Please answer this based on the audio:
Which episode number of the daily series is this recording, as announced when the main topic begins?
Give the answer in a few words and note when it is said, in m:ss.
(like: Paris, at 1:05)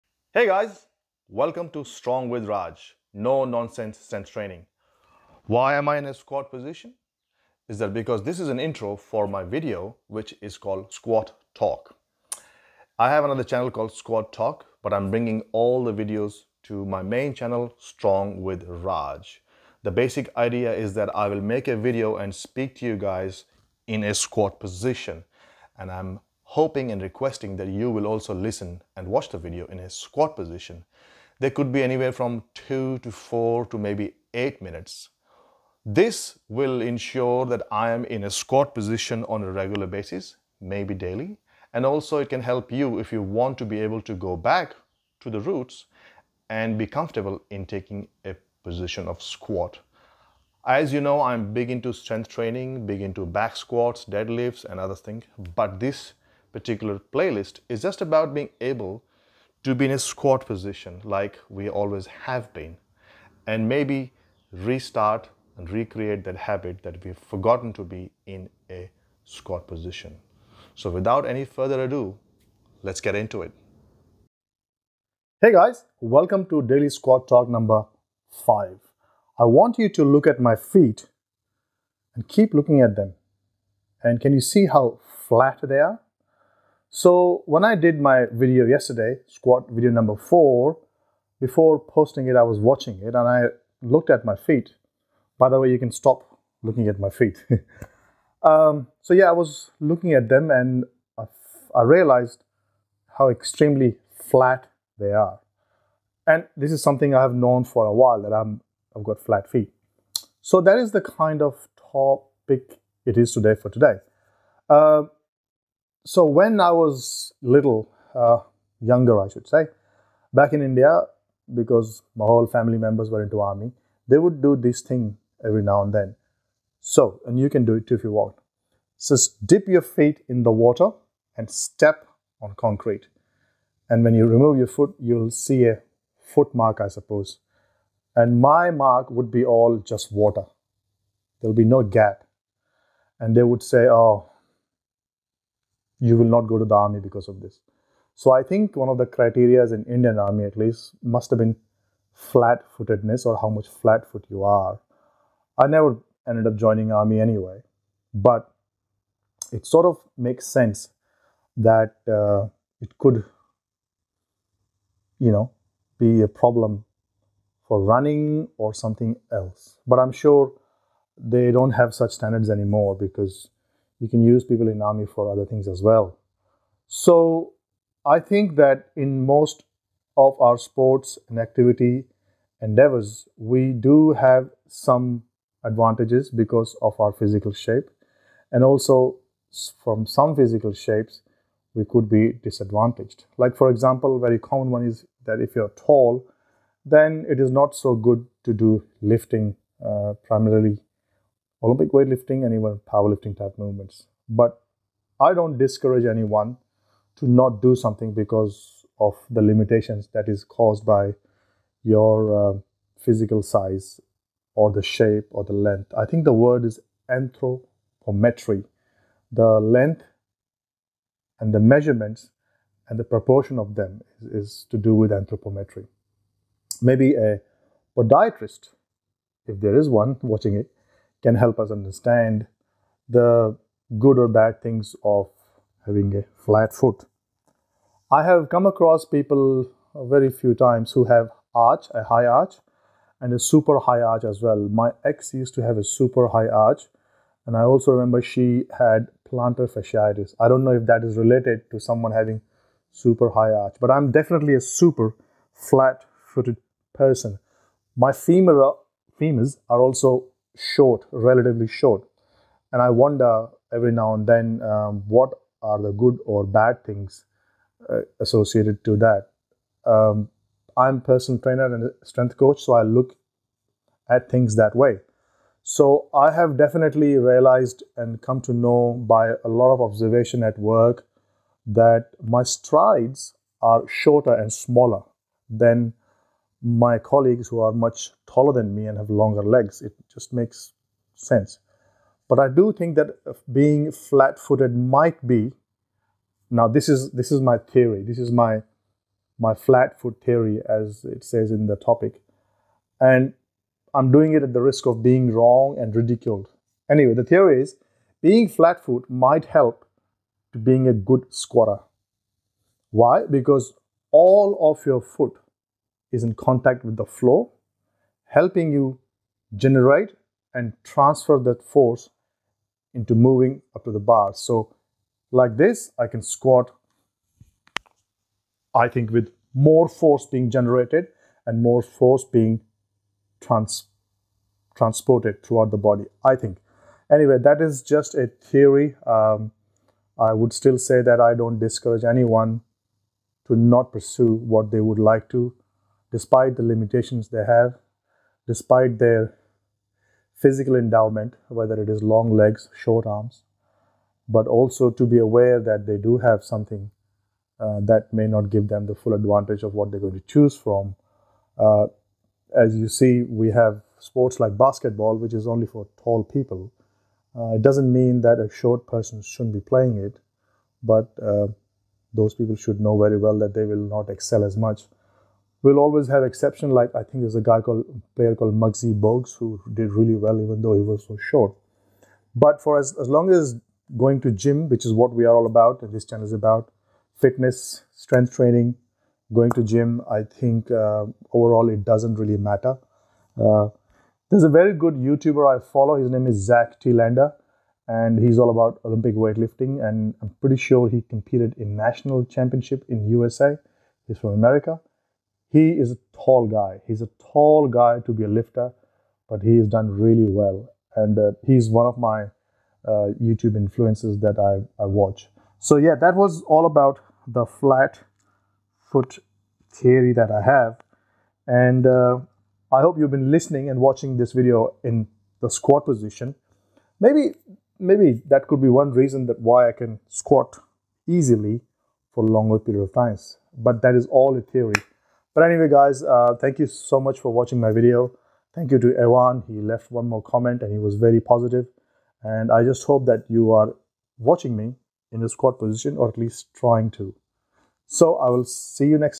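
5, at 1:17.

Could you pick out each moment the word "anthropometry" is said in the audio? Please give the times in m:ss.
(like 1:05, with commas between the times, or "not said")
3:37, 3:45.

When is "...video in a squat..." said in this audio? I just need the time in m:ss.
0:29.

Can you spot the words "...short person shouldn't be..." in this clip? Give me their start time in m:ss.
6:08.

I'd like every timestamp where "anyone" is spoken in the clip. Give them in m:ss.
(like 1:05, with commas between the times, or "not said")
3:26, 5:42.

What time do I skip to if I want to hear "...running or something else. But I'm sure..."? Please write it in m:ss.
2:47.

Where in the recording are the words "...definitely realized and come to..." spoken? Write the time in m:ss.
4:36.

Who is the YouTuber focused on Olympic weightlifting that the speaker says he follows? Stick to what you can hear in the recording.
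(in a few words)
Zack Telander.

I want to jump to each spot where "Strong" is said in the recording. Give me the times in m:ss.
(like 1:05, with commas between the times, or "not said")
0:01, 0:17.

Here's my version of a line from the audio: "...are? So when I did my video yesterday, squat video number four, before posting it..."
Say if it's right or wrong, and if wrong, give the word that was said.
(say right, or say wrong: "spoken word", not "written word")
right.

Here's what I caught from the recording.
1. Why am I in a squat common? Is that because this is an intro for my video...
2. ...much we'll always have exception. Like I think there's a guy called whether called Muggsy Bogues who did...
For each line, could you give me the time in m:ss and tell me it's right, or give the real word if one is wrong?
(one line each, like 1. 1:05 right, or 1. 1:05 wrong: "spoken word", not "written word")
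1. 0:05 wrong: "position", not "common"
2. 6:14 wrong: "player", not "whether".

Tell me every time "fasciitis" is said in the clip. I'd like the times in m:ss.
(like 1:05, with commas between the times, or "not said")
4:09.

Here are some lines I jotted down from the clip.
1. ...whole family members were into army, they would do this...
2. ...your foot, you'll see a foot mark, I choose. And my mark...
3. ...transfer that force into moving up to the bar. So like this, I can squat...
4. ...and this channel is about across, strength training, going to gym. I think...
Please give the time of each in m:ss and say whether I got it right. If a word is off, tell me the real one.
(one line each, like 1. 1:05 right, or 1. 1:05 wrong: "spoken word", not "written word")
1. 2:02 right
2. 2:14 wrong: "suppose", not "choose"
3. 5:20 right
4. 6:25 wrong: "fitness", not "across".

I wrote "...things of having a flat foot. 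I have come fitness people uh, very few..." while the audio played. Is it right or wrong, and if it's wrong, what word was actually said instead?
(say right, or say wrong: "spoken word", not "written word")
wrong: "across", not "fitness".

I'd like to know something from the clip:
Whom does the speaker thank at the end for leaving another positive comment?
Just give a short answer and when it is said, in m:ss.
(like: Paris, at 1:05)
Ewan, at 7:18.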